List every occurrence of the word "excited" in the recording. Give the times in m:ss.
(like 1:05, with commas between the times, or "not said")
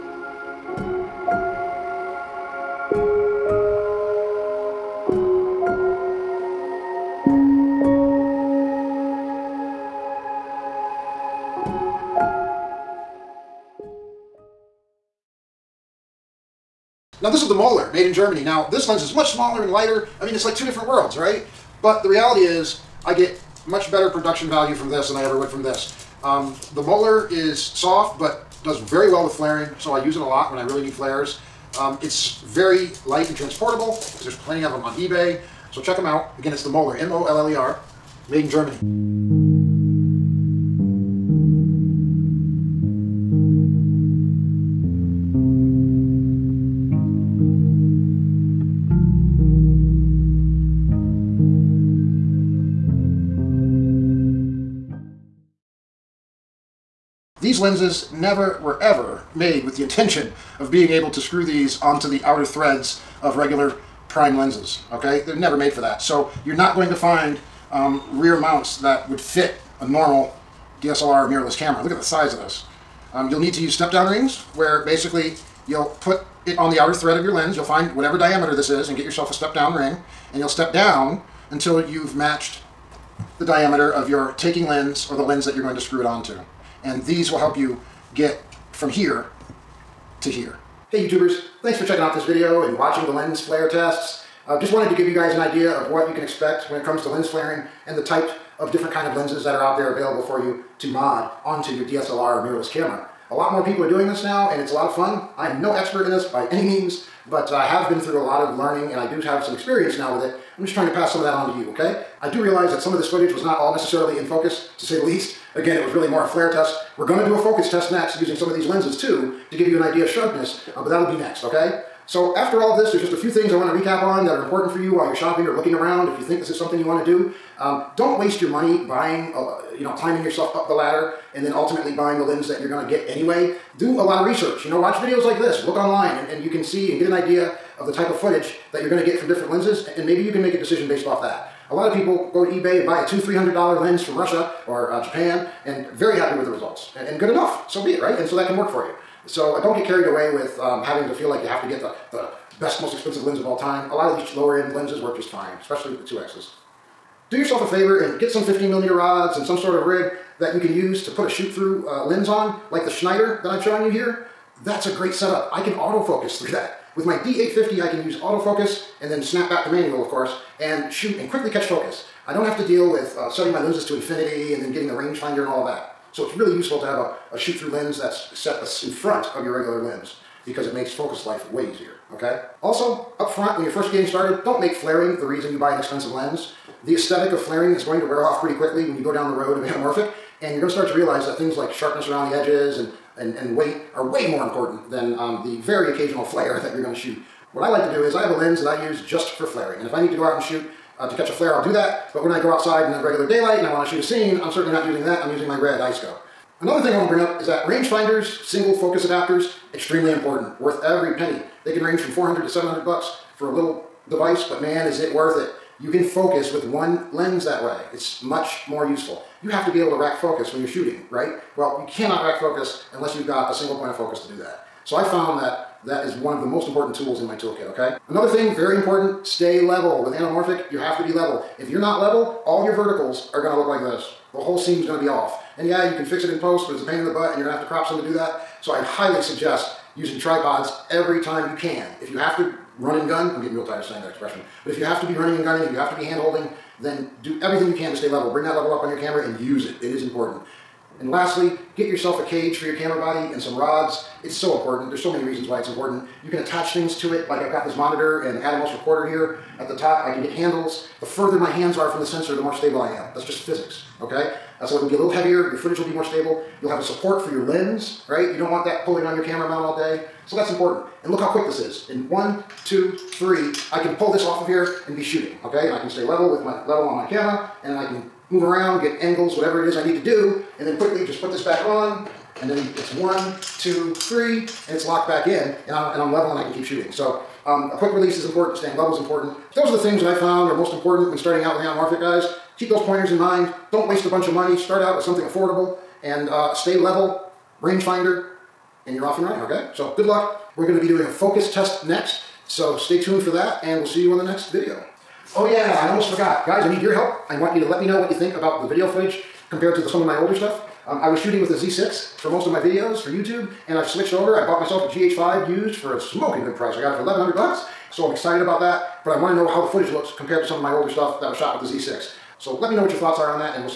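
5:18.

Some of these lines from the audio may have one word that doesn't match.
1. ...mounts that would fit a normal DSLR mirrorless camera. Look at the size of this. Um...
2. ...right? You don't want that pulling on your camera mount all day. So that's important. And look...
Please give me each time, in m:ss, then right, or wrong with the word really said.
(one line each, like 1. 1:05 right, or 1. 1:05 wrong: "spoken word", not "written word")
1. 1:08 right
2. 4:28 right.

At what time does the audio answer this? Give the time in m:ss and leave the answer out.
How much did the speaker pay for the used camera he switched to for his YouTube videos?
5:17.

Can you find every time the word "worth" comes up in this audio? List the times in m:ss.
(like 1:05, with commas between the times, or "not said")
3:30, 3:35.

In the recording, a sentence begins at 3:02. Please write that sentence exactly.
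Also, up front, when you're first getting started, don't make flaring the reason you buy an expensive lens.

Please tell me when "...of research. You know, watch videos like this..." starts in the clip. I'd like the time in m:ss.
2:14.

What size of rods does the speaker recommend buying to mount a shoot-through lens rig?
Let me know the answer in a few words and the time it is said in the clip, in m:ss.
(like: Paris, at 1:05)
15 millimeter, at 2:38.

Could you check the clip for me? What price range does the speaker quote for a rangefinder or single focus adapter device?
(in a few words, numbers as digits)
400 to 700 dollars.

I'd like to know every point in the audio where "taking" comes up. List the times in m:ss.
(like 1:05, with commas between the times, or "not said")
1:24.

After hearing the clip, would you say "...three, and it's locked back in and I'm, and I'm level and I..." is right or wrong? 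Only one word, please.
right.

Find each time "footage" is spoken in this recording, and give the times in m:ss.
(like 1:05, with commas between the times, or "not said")
1:53, 2:18, 4:25, 5:08, 5:19.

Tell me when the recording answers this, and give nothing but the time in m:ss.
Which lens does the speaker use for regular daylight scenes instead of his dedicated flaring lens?
3:25.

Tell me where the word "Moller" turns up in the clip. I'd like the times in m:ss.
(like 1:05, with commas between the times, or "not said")
0:17, 0:26, 0:36.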